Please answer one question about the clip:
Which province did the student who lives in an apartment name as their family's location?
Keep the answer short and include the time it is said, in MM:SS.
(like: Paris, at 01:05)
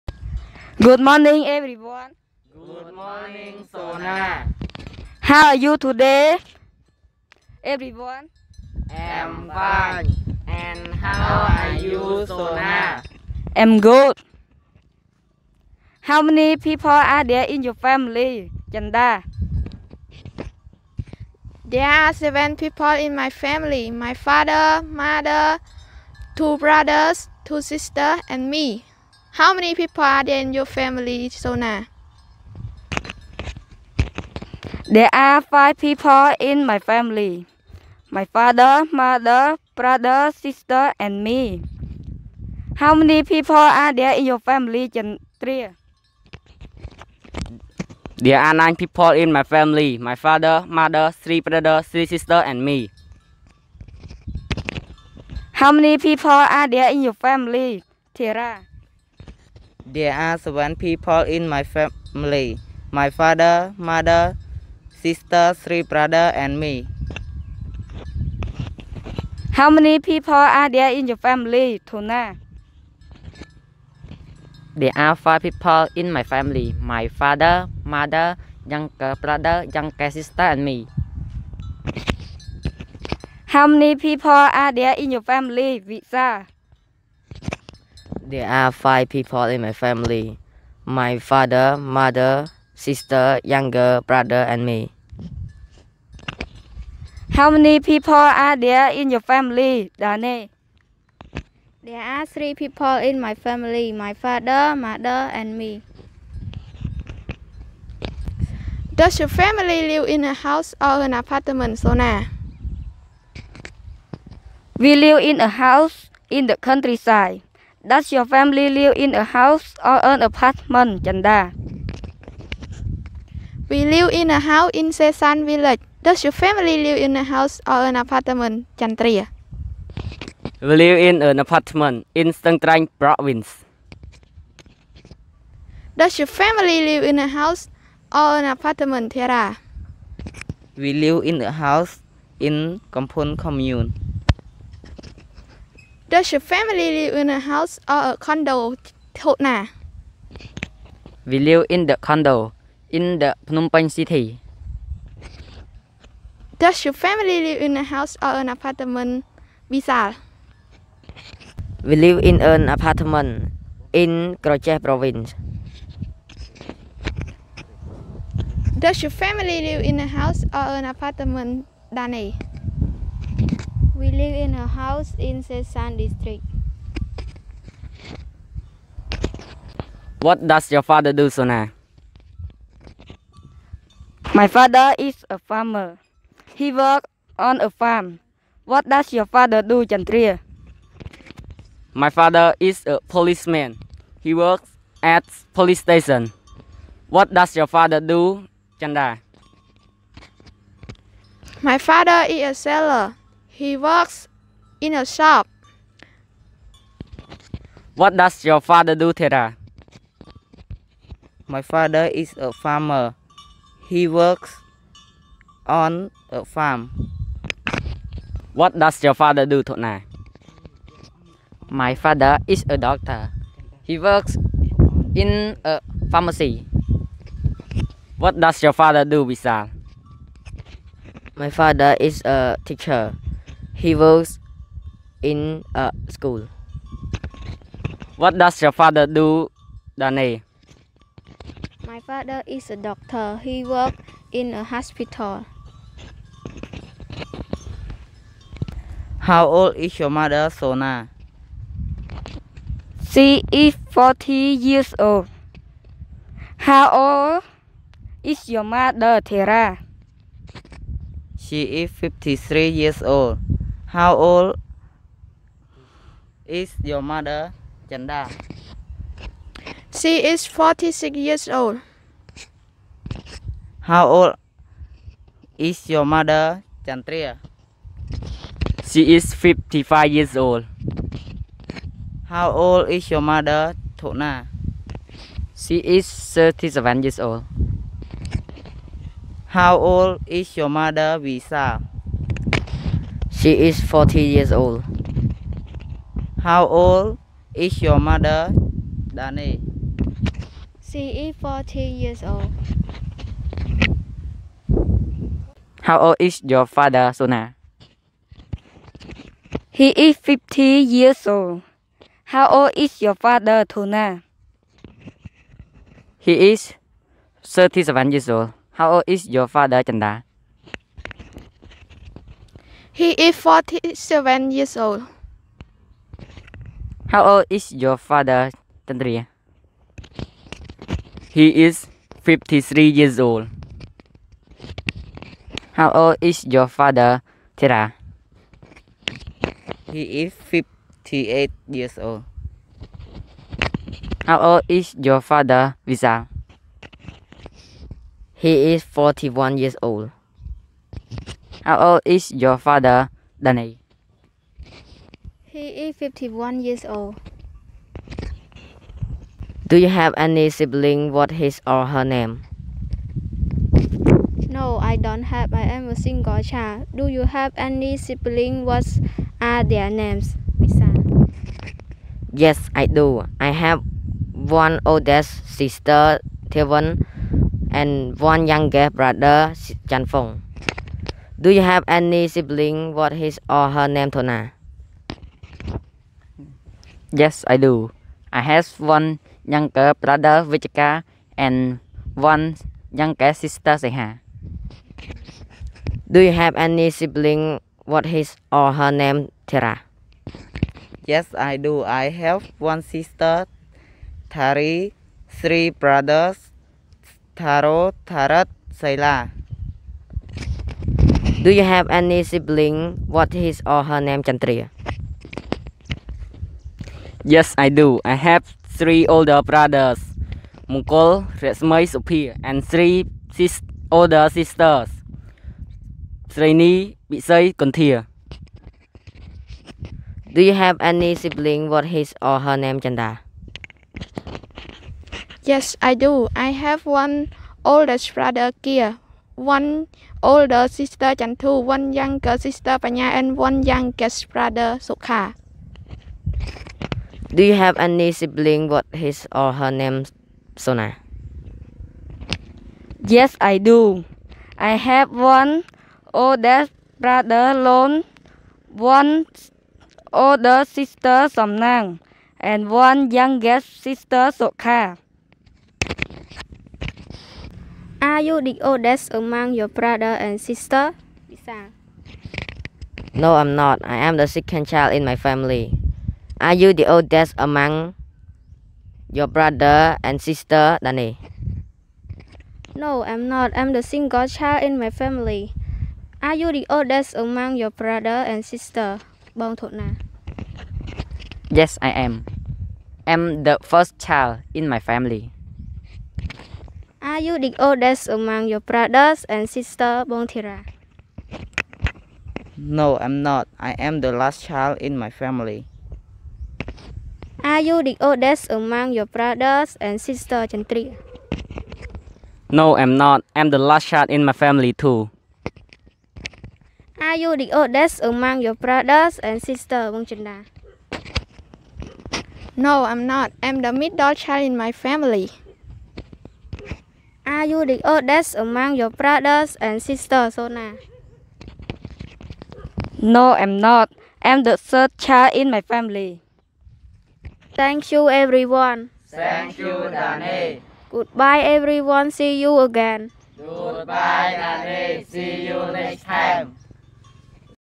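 Stung Treng province, at 02:12.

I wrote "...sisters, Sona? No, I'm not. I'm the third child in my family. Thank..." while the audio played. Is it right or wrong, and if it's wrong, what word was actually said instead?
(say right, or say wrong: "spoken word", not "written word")
right.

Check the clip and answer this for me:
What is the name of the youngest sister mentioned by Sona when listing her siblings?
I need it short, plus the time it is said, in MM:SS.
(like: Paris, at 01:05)
Sokha, at 07:44.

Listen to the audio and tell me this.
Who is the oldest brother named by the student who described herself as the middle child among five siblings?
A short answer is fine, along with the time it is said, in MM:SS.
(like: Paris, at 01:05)
Kia, at 07:18.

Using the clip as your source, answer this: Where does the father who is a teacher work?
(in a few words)
a school.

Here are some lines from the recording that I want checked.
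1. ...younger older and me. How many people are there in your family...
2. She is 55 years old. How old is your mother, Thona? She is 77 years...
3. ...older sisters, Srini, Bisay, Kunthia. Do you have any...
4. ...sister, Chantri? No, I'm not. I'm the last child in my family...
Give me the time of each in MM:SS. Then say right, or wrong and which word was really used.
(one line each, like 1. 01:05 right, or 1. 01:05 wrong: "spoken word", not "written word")
1. 01:33 wrong: "brother", not "older"
2. 04:38 wrong: "37", not "77"
3. 07:03 right
4. 08:30 right.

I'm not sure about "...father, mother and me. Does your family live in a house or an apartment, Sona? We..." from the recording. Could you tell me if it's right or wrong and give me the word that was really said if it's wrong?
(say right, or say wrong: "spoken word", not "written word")
right.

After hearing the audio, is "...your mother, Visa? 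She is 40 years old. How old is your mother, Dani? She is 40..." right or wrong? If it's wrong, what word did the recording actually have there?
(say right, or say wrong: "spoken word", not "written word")
right.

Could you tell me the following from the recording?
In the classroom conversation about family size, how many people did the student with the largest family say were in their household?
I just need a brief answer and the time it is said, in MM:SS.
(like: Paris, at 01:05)
9, at 00:48.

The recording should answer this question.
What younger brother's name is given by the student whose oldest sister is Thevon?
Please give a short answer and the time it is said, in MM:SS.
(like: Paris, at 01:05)
Chanfong, at 06:19.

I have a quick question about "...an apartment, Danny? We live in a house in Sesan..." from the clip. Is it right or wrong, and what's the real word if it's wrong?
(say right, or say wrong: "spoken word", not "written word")
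right.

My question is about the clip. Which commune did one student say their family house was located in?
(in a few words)
Kampung commune.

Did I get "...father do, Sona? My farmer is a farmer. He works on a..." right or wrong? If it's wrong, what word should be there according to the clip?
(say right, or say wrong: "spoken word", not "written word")
wrong: "father", not "farmer".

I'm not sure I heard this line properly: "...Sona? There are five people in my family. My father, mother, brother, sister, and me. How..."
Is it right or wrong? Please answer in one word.
right.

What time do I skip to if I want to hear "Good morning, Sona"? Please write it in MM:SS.
00:02.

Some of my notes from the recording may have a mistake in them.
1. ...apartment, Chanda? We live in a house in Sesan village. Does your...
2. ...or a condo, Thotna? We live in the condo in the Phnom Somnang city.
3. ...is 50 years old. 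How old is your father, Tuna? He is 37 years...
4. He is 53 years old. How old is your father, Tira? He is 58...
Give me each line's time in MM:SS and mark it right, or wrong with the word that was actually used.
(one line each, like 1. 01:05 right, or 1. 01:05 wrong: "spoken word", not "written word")
1. 02:00 right
2. 02:27 wrong: "Penh", not "Somnang"
3. 05:09 right
4. 05:31 right.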